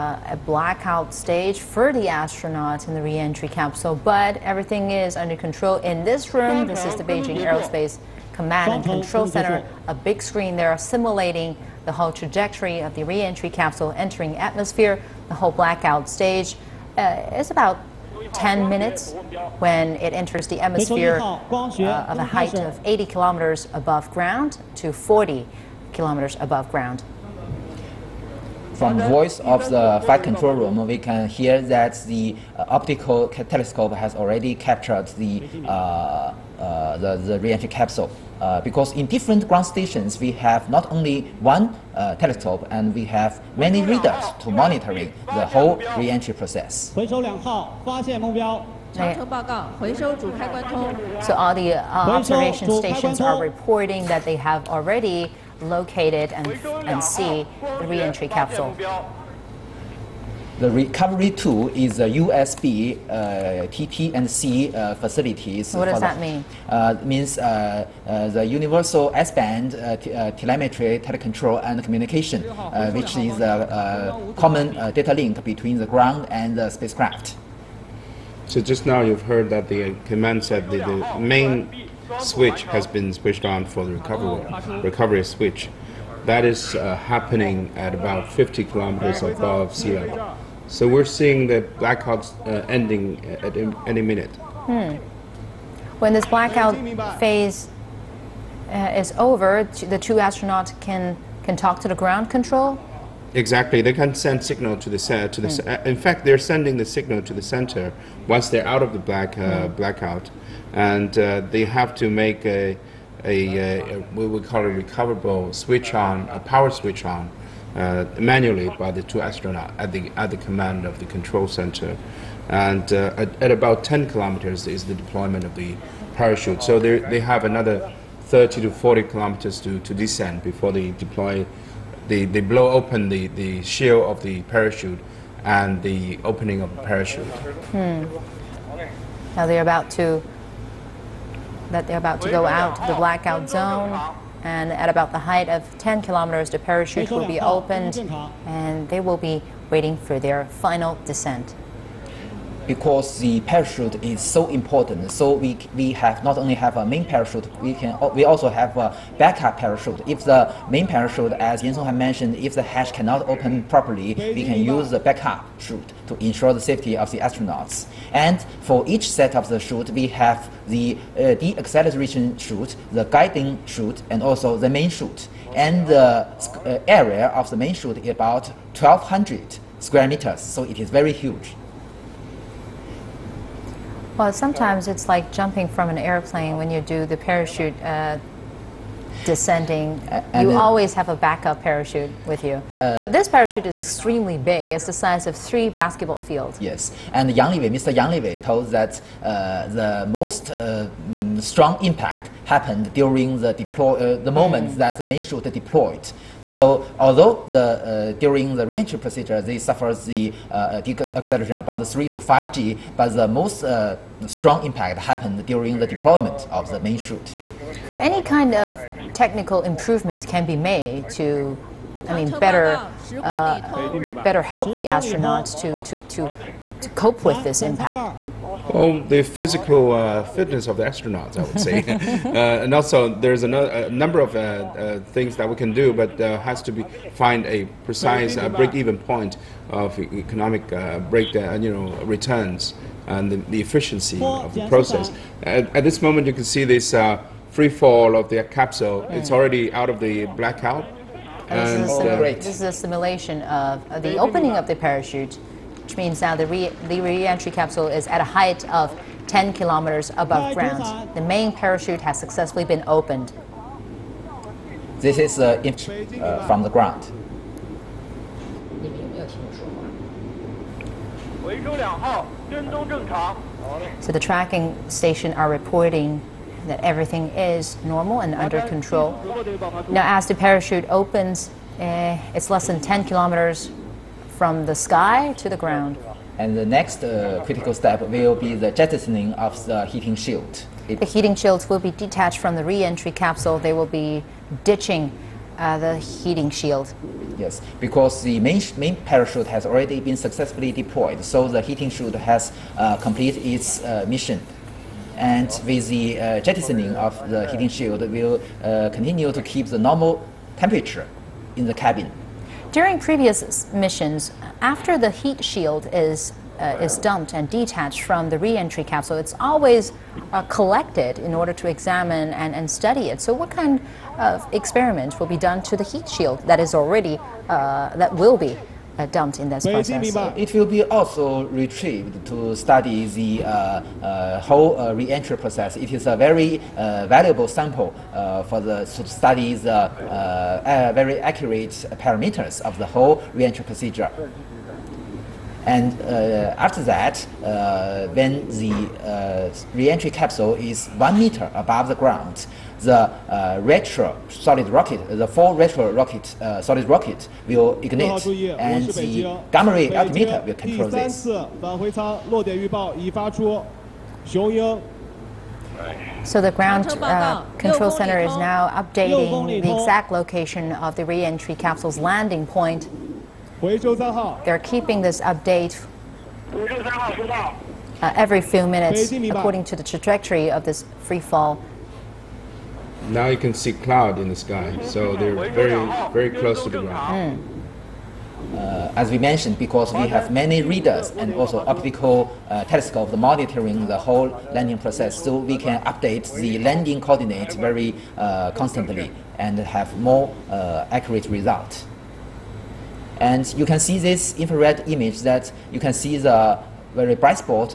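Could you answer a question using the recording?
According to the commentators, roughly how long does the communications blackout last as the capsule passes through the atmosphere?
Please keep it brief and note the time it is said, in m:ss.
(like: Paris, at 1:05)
10 minutes, at 0:18.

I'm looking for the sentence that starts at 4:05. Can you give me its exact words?
At, at, this moment, you can see this free fall of the capsule.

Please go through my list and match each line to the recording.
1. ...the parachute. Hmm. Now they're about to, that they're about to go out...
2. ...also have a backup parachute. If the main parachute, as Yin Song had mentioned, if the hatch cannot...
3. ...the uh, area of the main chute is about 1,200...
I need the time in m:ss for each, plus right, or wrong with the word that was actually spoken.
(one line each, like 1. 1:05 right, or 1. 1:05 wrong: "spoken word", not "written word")
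1. 2:16 right
2. 2:38 right
3. 2:55 right.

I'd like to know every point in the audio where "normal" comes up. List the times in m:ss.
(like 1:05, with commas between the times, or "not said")
4:37, 5:09.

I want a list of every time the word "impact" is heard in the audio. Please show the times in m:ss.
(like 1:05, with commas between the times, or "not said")
3:21, 3:34, 3:47.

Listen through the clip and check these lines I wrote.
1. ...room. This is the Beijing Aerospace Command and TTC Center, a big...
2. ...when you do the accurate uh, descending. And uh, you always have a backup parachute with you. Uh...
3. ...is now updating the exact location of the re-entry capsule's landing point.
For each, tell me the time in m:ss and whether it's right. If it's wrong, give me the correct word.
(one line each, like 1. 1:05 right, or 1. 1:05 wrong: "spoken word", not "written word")
1. 0:06 wrong: "Control", not "TTC"
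2. 3:06 wrong: "parachute", not "accurate"
3. 6:08 right.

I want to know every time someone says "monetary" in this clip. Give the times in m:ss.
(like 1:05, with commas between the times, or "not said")
not said.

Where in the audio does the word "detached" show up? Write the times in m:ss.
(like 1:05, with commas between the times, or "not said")
4:51, 5:17.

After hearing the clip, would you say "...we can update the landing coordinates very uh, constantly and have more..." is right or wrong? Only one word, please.
right.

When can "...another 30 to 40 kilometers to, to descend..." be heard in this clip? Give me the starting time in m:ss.
2:07.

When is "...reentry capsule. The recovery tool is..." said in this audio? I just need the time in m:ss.
0:57.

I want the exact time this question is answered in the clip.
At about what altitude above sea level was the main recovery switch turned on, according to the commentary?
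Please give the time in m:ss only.
1:28.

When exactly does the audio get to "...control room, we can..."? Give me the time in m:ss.
0:30.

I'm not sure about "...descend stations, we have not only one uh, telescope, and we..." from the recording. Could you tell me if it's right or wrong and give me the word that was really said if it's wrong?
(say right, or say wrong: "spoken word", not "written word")
wrong: "ground", not "descend".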